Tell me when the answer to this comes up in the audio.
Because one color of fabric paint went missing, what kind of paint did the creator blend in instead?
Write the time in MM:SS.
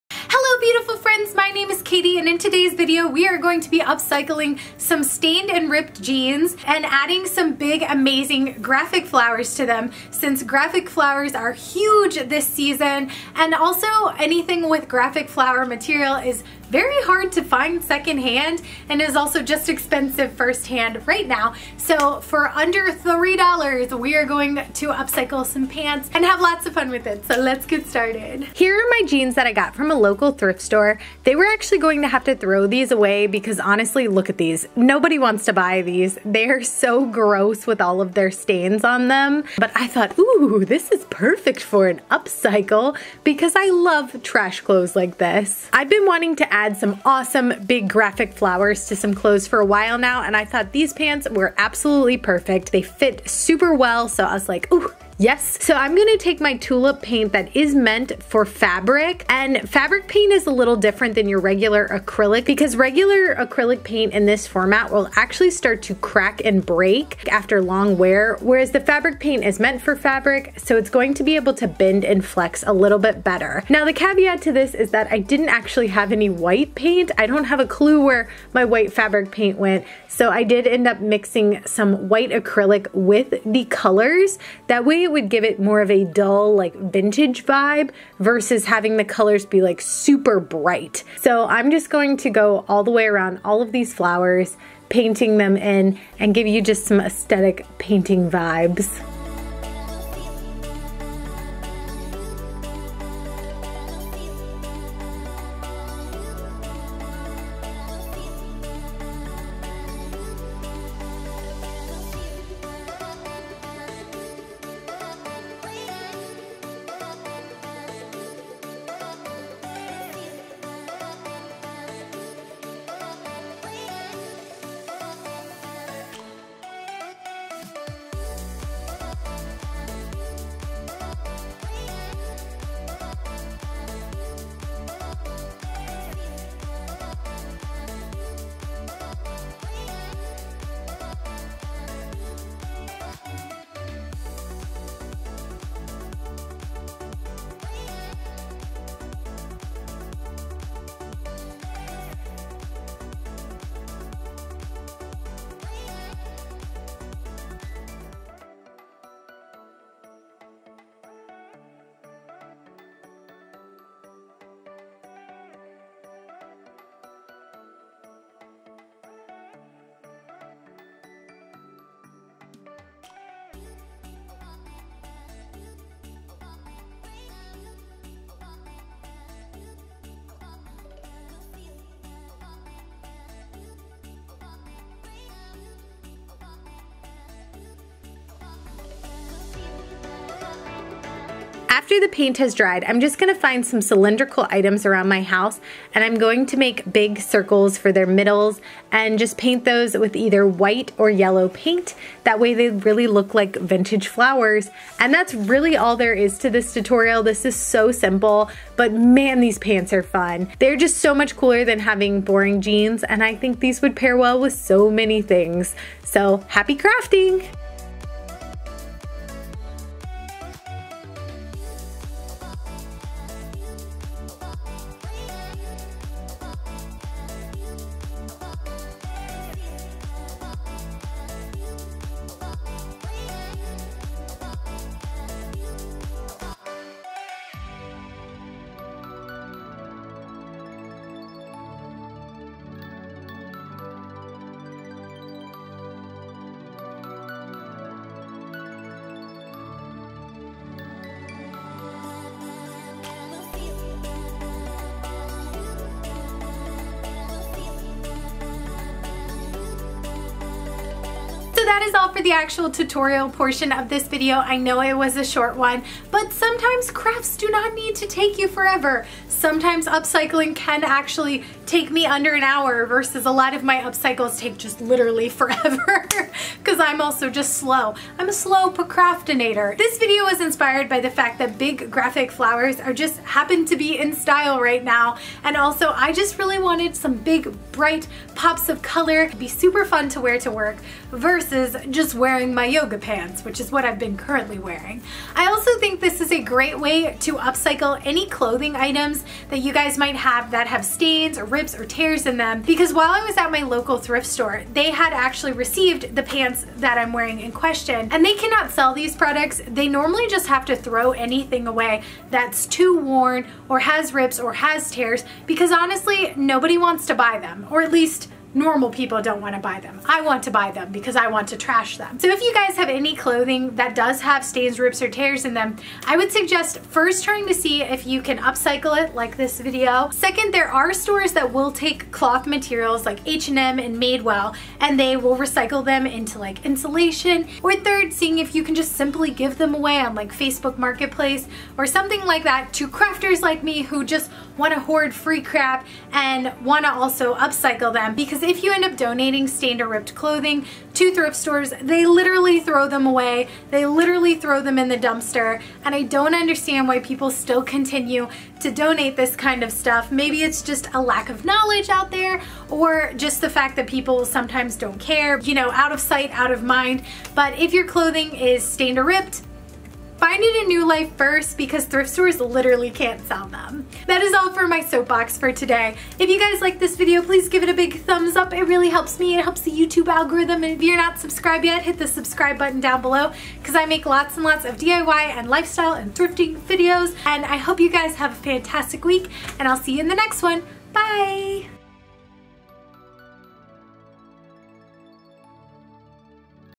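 01:22.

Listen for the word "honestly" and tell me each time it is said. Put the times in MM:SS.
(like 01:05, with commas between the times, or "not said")
00:33, 05:15.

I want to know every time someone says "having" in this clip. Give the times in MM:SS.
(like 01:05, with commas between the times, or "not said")
01:28, 03:31.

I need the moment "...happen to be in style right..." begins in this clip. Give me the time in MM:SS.
04:43.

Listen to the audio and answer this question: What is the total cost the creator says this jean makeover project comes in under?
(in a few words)
$3.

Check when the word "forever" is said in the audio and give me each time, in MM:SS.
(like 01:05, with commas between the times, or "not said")
04:28, 04:35.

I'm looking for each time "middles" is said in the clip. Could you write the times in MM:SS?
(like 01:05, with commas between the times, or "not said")
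03:18.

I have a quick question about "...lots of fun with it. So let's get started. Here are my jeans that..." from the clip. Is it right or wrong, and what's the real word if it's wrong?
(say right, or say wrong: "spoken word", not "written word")
right.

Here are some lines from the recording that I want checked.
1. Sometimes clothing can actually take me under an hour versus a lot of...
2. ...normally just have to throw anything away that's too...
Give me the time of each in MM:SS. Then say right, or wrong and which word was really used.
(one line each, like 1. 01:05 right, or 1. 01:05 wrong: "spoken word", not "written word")
1. 04:29 wrong: "upcycling", not "clothing"
2. 05:09 right.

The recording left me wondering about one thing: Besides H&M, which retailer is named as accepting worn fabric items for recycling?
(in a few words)
Madewell.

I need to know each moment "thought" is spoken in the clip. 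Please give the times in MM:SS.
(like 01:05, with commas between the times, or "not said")
00:39, 00:50.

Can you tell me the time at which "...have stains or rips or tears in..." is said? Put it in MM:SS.
05:00.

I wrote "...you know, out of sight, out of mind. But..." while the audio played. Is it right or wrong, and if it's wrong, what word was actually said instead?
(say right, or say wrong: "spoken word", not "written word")
right.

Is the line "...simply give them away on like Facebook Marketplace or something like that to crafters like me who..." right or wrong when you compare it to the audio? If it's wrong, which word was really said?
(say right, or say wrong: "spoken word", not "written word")
right.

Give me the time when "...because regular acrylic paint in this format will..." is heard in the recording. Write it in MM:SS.
01:02.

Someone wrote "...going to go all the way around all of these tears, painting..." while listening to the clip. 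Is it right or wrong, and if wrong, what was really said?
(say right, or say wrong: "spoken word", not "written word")
wrong: "flowers", not "tears".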